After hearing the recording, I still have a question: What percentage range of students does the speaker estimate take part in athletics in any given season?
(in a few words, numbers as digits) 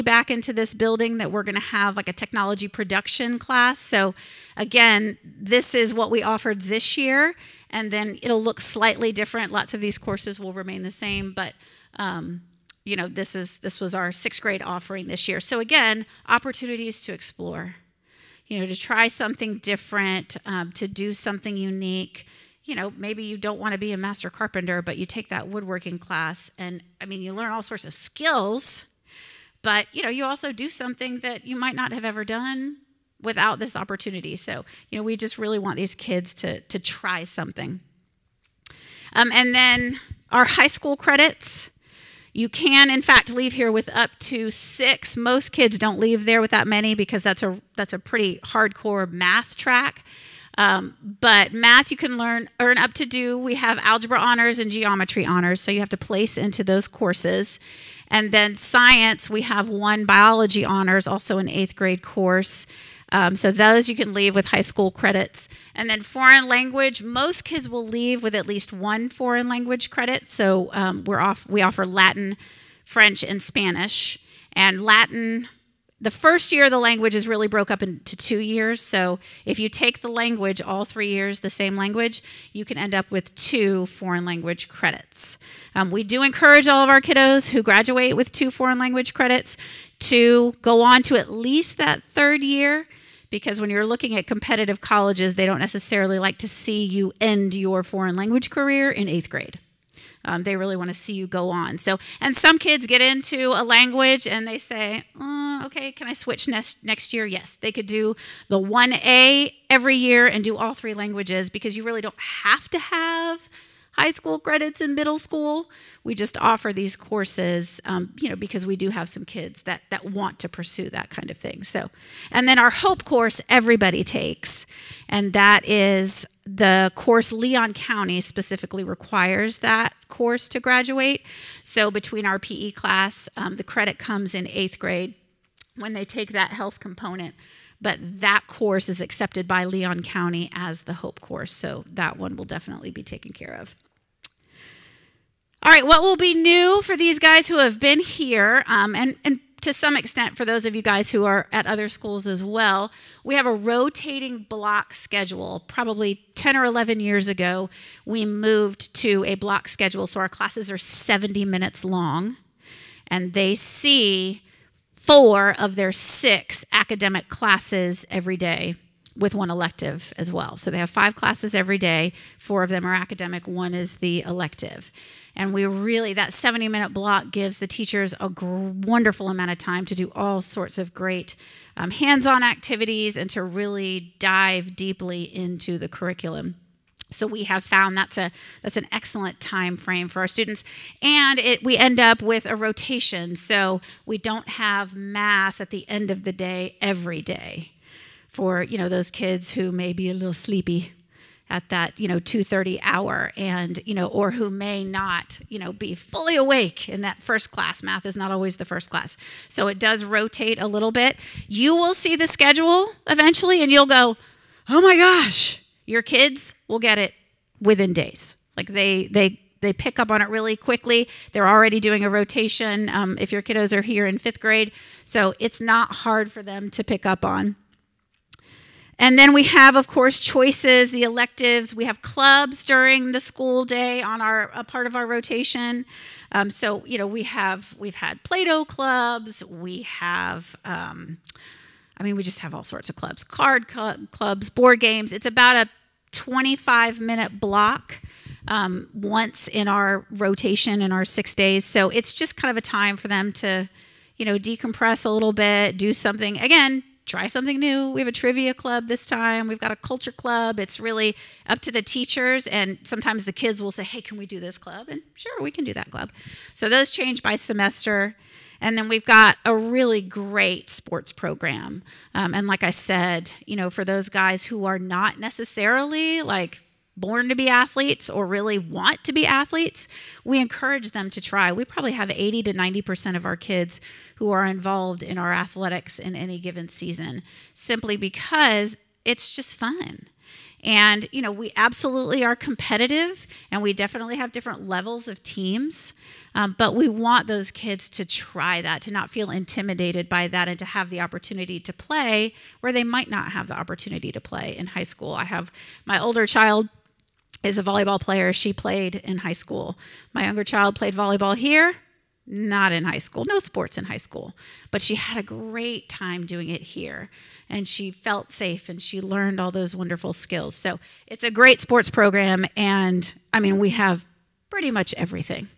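80 to 90%.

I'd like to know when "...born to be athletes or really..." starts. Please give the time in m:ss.
4:36.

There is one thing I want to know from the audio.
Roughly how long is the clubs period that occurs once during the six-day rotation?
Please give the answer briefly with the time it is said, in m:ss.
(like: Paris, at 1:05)
25 minutes, at 4:06.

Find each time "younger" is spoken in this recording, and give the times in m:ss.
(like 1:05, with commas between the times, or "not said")
5:10.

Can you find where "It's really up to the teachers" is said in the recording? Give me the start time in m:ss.
4:20.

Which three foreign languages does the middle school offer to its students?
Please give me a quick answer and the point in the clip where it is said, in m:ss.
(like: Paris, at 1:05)
Latin, French, and Spanish, at 1:11.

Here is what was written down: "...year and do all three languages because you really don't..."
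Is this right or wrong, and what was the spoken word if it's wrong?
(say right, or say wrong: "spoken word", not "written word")
right.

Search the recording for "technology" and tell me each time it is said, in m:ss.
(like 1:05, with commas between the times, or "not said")
0:02.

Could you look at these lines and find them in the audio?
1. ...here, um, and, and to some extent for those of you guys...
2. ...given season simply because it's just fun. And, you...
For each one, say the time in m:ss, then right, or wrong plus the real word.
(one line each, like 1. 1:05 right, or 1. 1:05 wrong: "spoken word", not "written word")
1. 2:27 right
2. 4:46 right.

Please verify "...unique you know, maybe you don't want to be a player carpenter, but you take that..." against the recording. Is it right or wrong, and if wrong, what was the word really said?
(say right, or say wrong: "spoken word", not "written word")
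wrong: "master", not "player".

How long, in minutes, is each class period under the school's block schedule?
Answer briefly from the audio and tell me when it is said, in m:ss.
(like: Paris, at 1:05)
70 minutes, at 2:40.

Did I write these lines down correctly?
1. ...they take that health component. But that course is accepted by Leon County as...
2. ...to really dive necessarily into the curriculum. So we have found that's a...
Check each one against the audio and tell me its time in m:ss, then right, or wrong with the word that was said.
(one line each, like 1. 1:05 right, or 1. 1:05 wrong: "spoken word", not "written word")
1. 2:15 right
2. 3:03 wrong: "deeply", not "necessarily".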